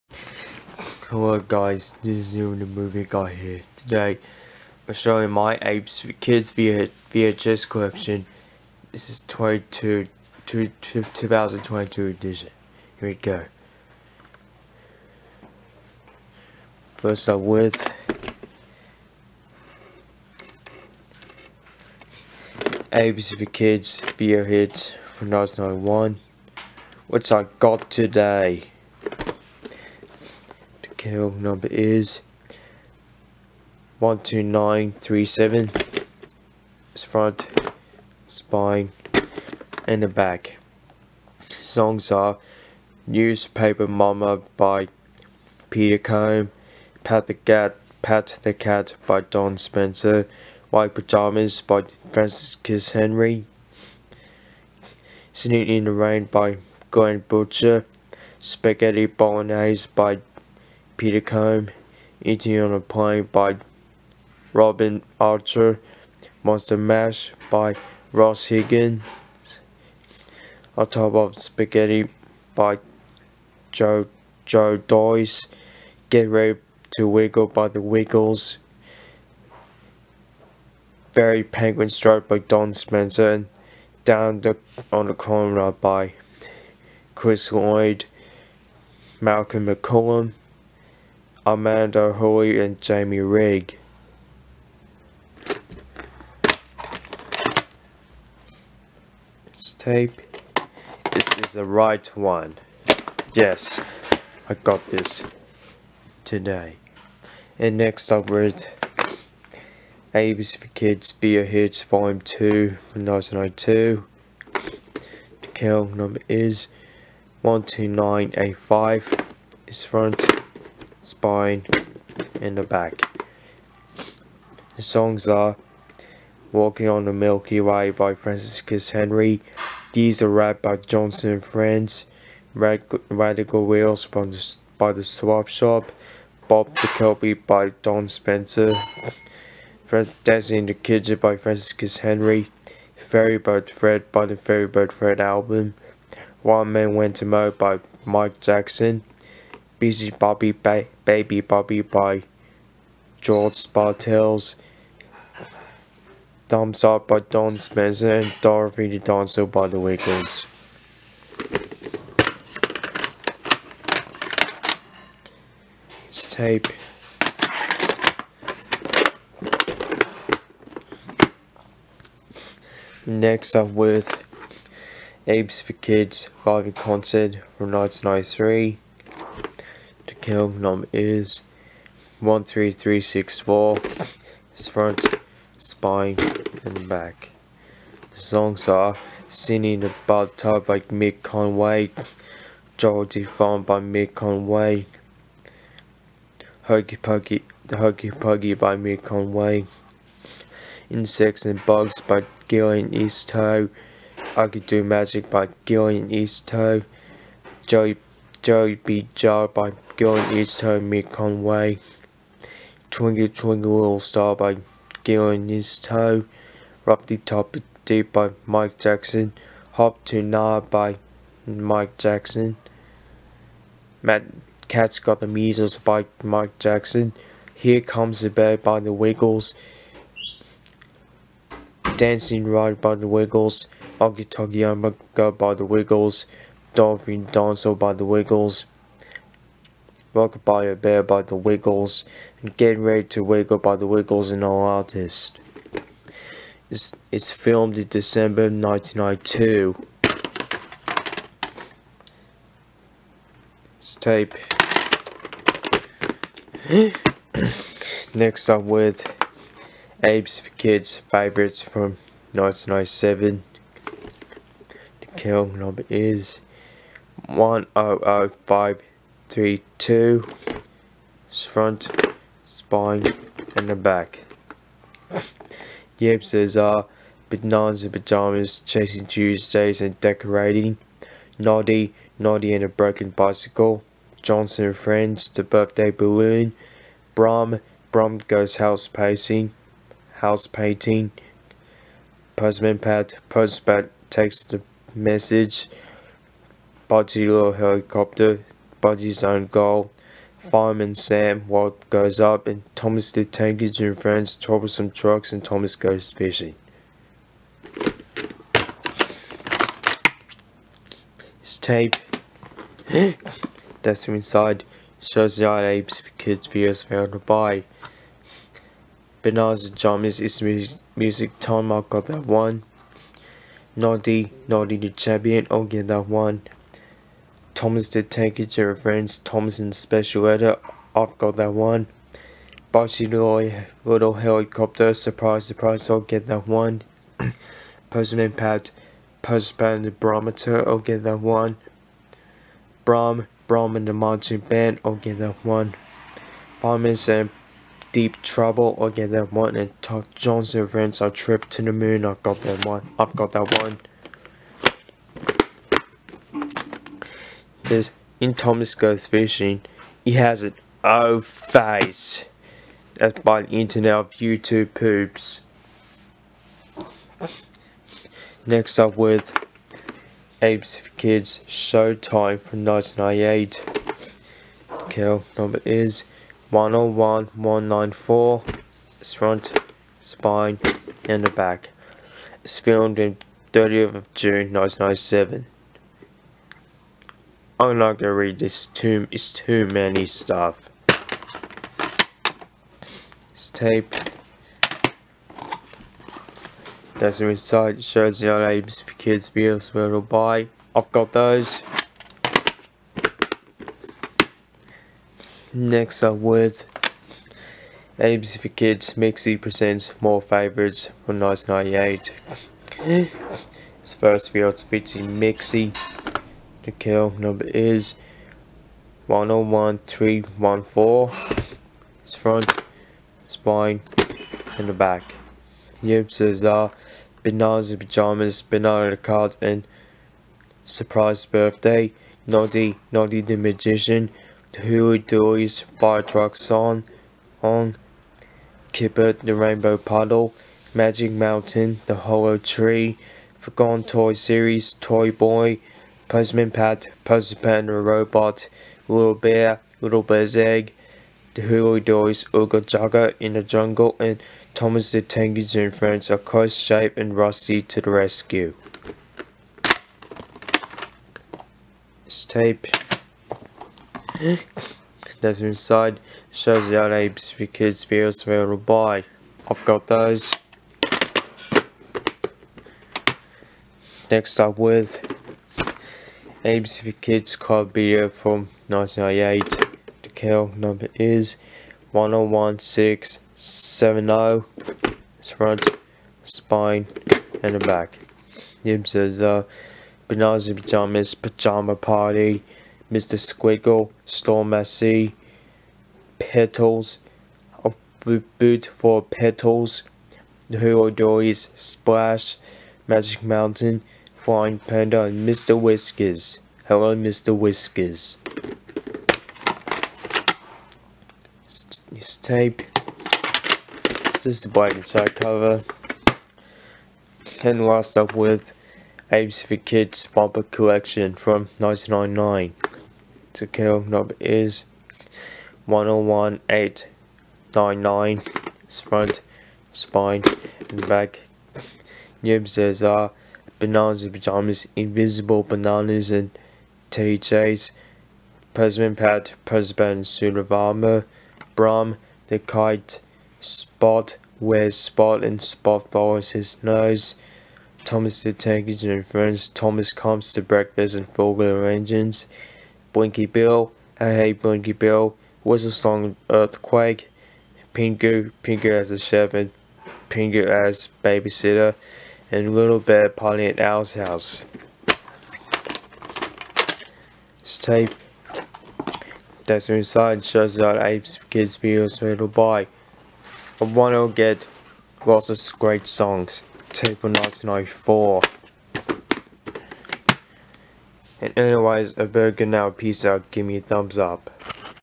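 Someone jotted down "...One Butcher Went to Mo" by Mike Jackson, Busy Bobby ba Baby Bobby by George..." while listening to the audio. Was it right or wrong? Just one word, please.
wrong.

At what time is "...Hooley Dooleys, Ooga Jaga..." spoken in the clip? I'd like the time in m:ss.
7:31.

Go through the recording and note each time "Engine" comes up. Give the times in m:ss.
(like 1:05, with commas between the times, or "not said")
5:03, 7:35, 9:11.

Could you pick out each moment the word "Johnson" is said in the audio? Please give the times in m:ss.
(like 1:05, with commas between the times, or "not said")
2:10, 4:44, 5:50.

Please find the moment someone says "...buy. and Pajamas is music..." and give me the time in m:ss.
5:17.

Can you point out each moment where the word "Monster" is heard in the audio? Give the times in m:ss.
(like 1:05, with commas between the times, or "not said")
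1:06.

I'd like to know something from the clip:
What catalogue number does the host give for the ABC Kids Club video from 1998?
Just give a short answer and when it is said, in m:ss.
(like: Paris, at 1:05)
101670, at 8:01.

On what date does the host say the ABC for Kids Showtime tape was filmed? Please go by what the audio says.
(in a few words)
30th of June 1997.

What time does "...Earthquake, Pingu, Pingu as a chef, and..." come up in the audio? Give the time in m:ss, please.
9:16.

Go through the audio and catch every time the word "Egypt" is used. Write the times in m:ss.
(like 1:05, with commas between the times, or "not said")
not said.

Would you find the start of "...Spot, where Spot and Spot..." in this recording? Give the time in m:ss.
9:03.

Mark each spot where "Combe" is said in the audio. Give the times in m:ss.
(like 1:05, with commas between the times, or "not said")
0:45, 1:01.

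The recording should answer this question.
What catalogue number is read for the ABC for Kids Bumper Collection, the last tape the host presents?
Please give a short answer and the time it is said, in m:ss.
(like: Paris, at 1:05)
101899, at 8:45.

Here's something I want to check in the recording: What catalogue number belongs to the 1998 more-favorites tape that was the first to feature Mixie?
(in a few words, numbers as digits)
101314.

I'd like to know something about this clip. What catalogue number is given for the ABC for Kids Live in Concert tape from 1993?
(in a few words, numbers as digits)
13364.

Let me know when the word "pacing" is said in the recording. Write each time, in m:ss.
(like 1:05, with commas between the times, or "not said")
4:48.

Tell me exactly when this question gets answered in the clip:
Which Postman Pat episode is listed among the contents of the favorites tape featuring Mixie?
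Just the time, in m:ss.
7:27.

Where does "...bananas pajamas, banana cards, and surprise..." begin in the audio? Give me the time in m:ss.
7:07.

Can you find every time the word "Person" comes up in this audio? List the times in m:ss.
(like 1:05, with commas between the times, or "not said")
5:37.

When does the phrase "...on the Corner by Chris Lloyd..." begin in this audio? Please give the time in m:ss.
1:24.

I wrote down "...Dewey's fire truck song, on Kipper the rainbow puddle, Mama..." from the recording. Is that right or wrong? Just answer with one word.
wrong.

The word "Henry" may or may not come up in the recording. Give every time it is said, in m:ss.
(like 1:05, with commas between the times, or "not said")
0:52, 2:08, 2:21.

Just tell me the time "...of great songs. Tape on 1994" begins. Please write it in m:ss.
9:35.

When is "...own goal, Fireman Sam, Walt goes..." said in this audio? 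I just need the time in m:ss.
4:59.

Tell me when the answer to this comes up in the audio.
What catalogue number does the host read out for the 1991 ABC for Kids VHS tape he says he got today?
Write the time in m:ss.
0:33.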